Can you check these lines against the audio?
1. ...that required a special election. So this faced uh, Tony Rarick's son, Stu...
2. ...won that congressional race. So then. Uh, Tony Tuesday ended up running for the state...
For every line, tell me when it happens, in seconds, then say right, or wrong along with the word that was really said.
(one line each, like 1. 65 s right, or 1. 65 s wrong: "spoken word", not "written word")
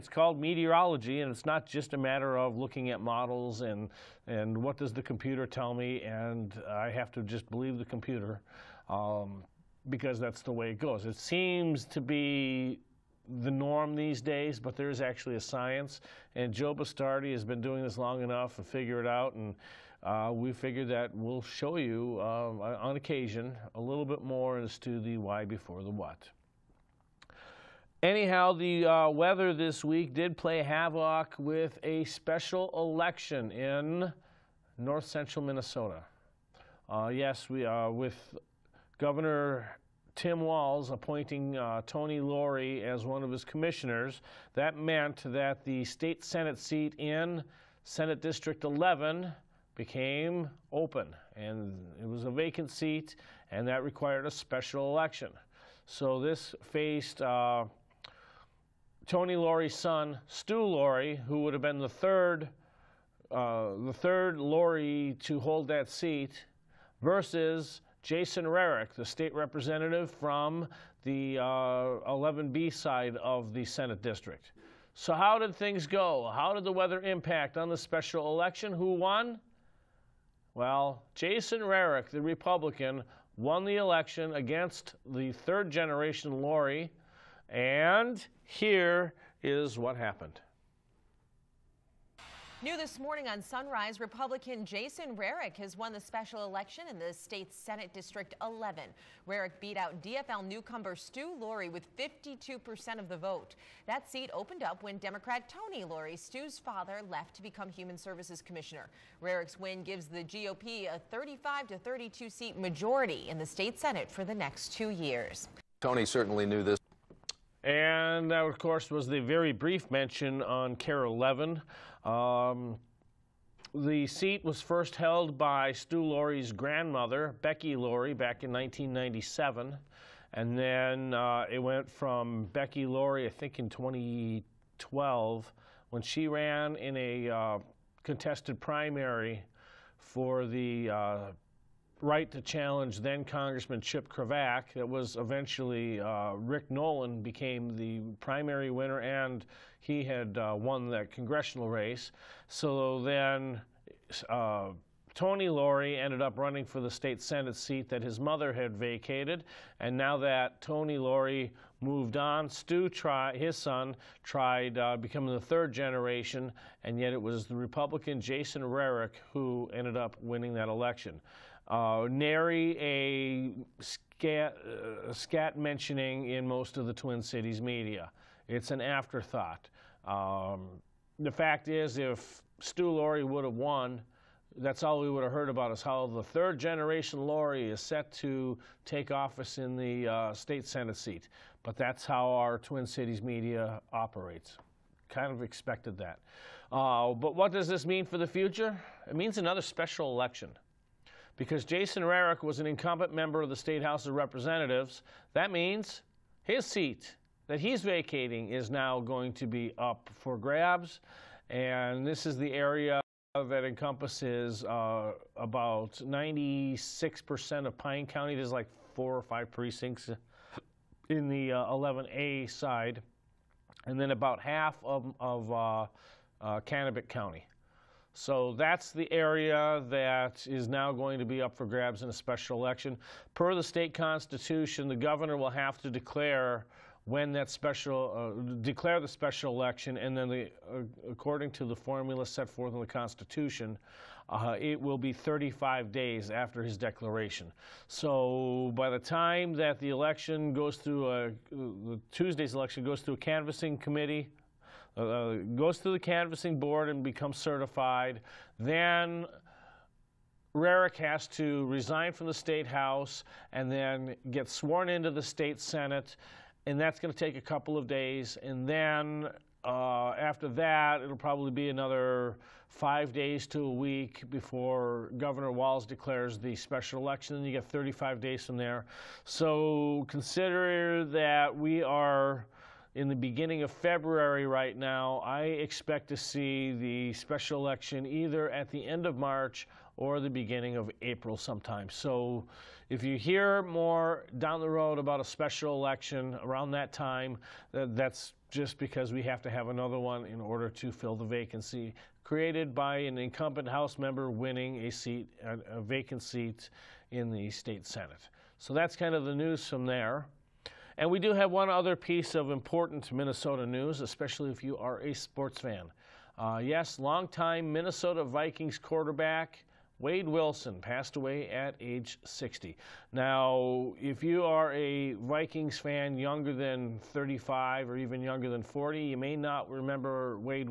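1. 53 s wrong: "Lourey", not "Rarick"
2. 150 s wrong: "Lourey", not "Tuesday".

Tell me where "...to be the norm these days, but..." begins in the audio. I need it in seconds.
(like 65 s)
11 s.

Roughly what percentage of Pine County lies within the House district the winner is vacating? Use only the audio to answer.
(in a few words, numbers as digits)
96%.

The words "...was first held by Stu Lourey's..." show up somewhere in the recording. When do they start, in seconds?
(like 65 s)
124 s.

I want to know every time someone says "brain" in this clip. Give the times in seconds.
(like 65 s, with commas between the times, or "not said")
not said.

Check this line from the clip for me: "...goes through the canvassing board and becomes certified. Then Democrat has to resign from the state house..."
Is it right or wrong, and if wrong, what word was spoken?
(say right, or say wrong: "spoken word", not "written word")
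wrong: "Rarick", not "Democrat".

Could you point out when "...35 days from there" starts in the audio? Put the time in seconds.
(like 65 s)
277 s.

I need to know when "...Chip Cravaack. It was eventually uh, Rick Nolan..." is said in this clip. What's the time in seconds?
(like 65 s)
143 s.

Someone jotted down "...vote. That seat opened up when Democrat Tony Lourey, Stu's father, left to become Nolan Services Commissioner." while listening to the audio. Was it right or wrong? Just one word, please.
wrong.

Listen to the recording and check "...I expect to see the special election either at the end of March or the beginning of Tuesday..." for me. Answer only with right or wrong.
wrong.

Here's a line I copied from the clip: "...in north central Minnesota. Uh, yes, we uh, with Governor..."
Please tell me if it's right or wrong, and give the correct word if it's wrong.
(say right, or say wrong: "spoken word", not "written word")
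right.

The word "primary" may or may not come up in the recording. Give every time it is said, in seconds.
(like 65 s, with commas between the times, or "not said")
138 s, 148 s.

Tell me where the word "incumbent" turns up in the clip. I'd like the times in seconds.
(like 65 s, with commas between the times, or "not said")
202 s, 303 s.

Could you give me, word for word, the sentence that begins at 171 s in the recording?
Uh, nary a scat, uh, scat, mentioning in most of the Twin Cities media.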